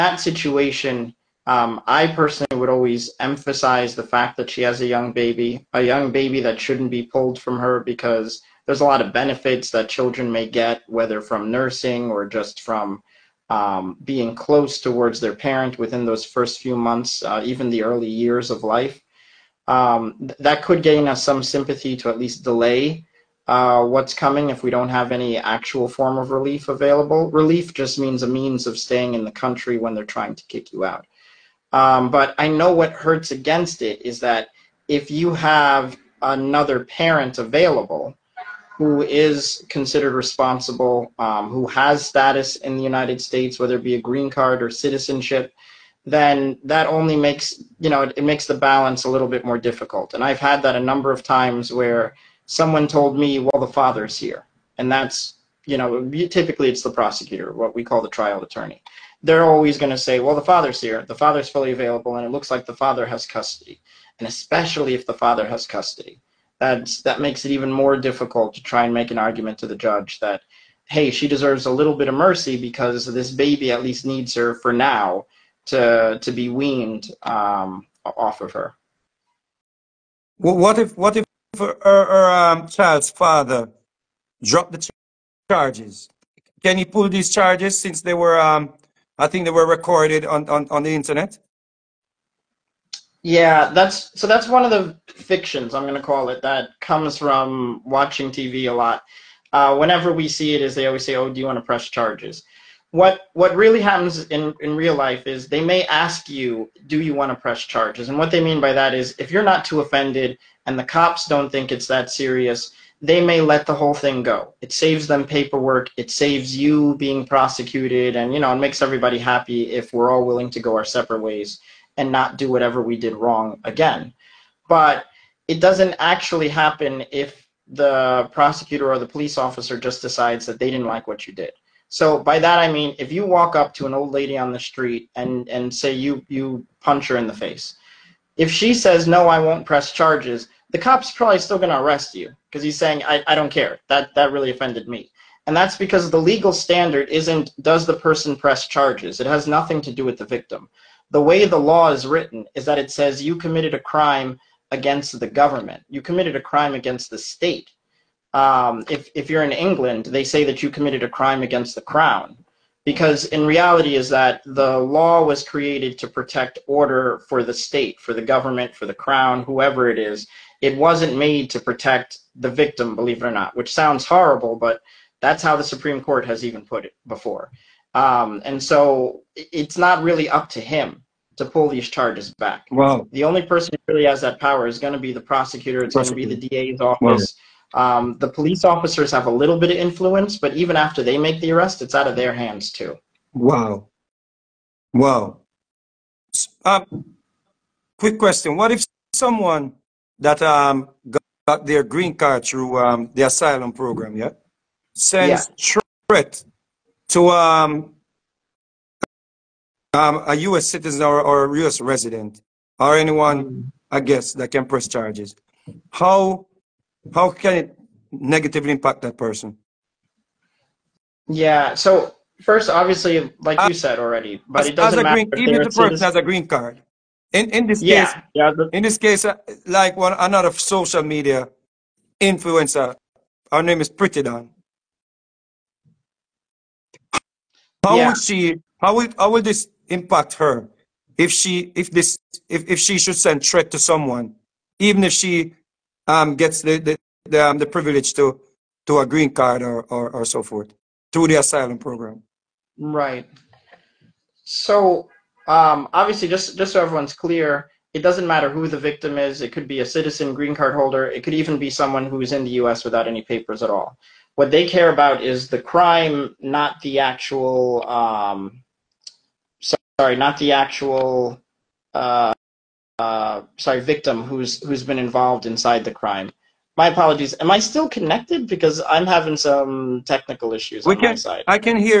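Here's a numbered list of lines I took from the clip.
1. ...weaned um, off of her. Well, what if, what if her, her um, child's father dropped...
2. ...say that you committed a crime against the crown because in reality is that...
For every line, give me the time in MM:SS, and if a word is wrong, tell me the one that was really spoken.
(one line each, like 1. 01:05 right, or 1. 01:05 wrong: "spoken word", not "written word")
1. 01:16 right
2. 02:40 right.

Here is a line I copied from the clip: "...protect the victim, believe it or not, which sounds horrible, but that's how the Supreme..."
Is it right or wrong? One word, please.
right.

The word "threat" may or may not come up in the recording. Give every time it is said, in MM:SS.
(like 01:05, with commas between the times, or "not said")
03:26, 04:03.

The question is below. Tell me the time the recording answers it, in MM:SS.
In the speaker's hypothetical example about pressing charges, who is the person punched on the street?
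02:13.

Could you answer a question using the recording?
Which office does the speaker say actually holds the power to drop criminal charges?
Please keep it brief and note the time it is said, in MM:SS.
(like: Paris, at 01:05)
the DA's office, at 03:06.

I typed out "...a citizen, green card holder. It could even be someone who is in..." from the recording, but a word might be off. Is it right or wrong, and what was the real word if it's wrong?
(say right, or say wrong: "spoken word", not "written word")
right.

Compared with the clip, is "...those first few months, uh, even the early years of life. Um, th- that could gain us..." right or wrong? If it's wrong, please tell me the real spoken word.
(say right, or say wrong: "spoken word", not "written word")
right.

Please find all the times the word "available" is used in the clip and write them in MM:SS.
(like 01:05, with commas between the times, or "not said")
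00:26, 00:37, 01:01.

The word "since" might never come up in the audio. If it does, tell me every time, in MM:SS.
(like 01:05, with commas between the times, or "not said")
01:27.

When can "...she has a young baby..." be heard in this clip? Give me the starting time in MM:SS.
00:04.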